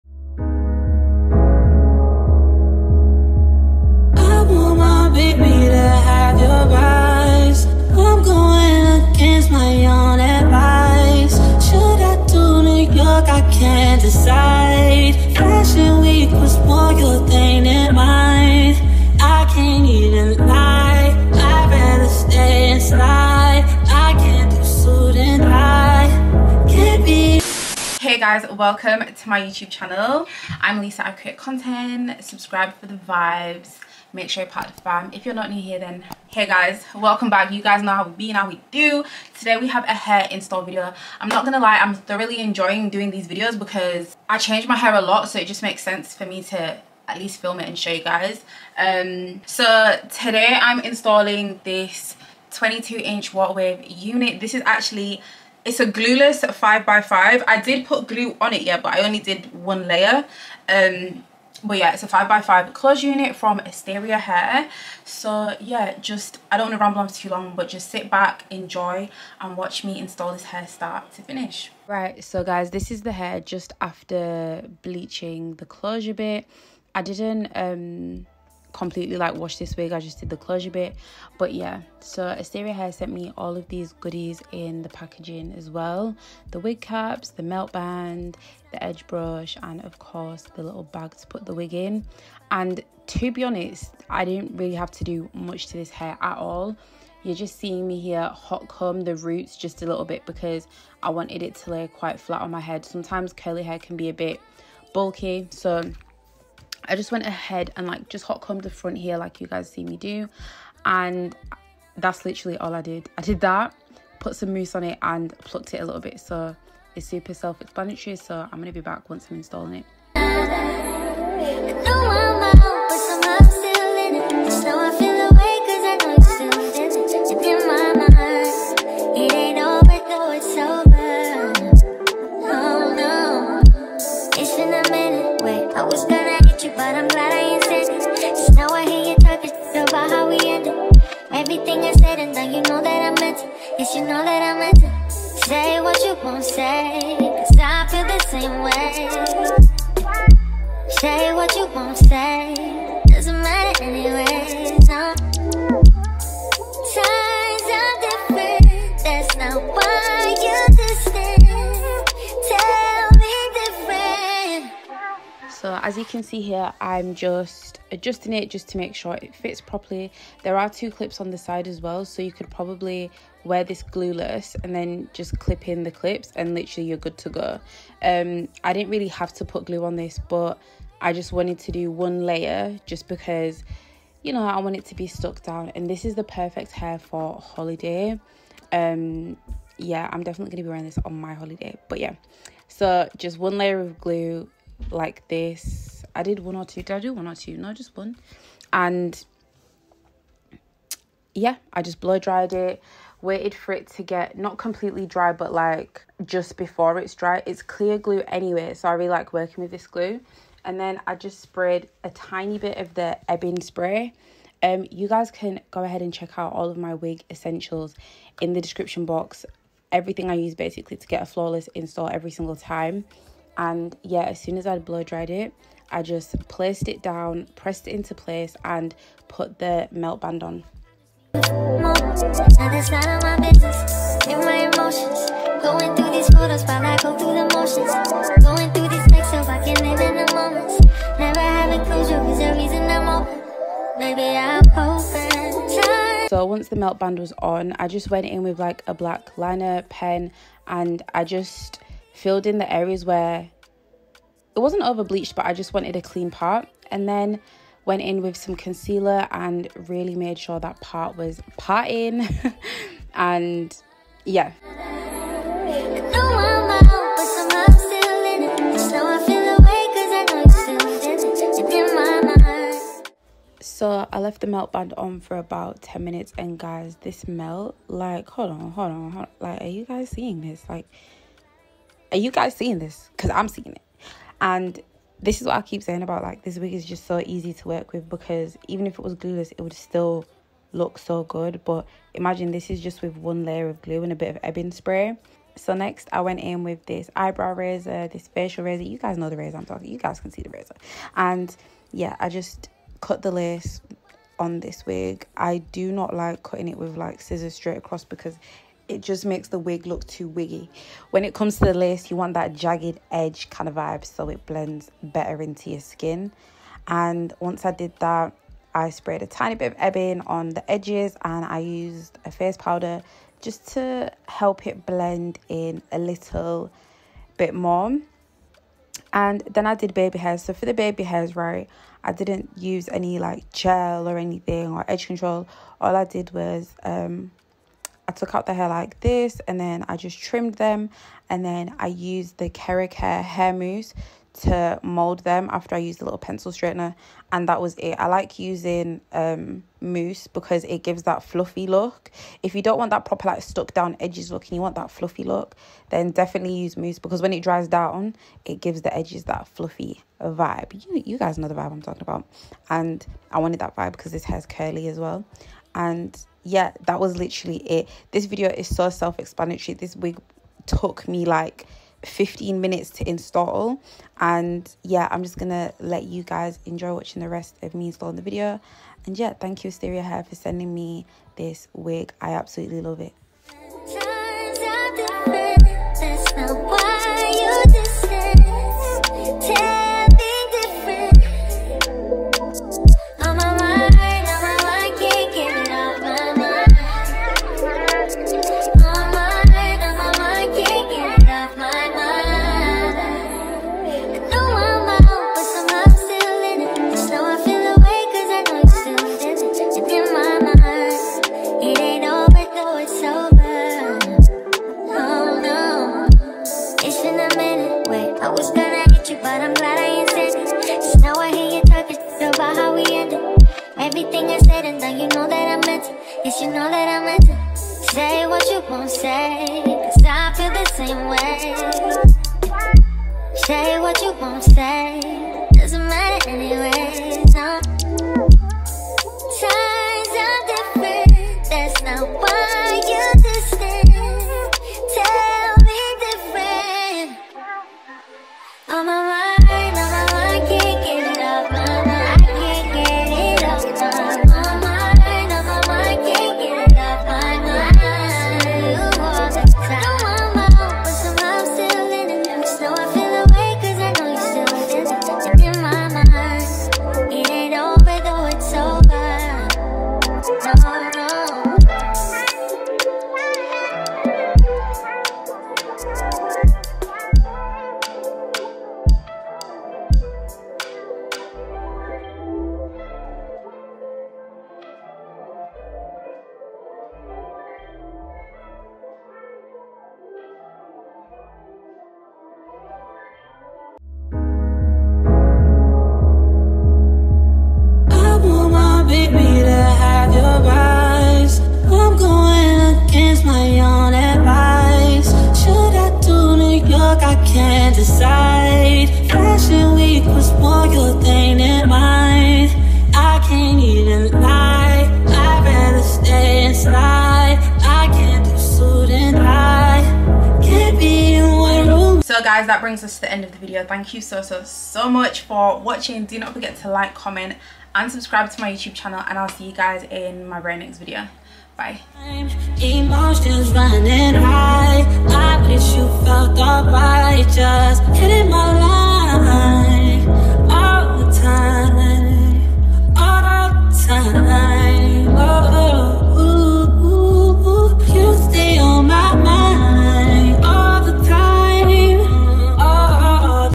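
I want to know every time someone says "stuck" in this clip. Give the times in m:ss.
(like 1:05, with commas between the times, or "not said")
3:05, 5:53.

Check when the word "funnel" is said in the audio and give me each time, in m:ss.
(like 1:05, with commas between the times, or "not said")
not said.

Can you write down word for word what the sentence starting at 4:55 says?
So next I went in with this eyebrow razor, this facial razor.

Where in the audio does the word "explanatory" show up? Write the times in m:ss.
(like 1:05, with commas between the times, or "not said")
1:57, 6:09.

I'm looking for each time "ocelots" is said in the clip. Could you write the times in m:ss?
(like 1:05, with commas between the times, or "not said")
not said.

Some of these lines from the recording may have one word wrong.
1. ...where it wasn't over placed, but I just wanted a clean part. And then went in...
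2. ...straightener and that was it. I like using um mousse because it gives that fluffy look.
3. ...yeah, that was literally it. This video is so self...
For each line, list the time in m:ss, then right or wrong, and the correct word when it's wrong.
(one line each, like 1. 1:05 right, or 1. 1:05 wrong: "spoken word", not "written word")
1. 4:13 wrong: "bleached", not "placed"
2. 5:46 right
3. 6:06 right.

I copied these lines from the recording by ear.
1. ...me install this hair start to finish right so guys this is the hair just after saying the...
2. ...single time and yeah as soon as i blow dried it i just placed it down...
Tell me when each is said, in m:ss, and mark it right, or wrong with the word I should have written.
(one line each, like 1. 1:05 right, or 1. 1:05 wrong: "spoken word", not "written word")
1. 1:09 wrong: "bleaching", not "saying"
2. 3:42 right.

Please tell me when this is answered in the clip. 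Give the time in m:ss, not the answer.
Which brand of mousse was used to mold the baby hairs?
5:42.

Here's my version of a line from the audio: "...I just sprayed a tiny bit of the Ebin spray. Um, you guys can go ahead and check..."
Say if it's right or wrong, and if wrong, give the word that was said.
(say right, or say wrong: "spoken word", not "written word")
right.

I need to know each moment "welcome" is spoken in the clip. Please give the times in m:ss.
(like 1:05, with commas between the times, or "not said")
0:28, 0:36.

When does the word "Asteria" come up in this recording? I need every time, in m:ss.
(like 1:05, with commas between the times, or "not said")
1:03, 1:22, 6:19.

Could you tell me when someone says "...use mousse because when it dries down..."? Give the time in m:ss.
5:56.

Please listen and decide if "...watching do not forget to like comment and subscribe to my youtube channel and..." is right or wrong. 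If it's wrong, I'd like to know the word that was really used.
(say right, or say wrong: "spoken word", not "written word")
right.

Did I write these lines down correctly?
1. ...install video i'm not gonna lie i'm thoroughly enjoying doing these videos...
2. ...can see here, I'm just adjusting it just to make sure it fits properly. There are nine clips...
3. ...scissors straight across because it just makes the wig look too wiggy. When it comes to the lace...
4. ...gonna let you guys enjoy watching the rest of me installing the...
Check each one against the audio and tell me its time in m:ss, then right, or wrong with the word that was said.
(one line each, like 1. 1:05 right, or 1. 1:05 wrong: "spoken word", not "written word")
1. 0:40 right
2. 2:46 wrong: "two", not "nine"
3. 5:07 right
4. 6:15 right.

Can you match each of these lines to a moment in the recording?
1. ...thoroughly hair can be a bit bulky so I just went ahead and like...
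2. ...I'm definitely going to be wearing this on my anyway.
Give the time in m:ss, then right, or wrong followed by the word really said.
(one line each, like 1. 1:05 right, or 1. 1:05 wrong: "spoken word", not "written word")
1. 1:43 wrong: "curly", not "thoroughly"
2. 3:10 wrong: "holiday", not "anyway".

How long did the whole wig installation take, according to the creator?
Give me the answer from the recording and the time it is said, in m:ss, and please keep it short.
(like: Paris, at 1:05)
15 minutes, at 6:12.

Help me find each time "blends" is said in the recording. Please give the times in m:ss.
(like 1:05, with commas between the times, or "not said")
5:14, 5:24.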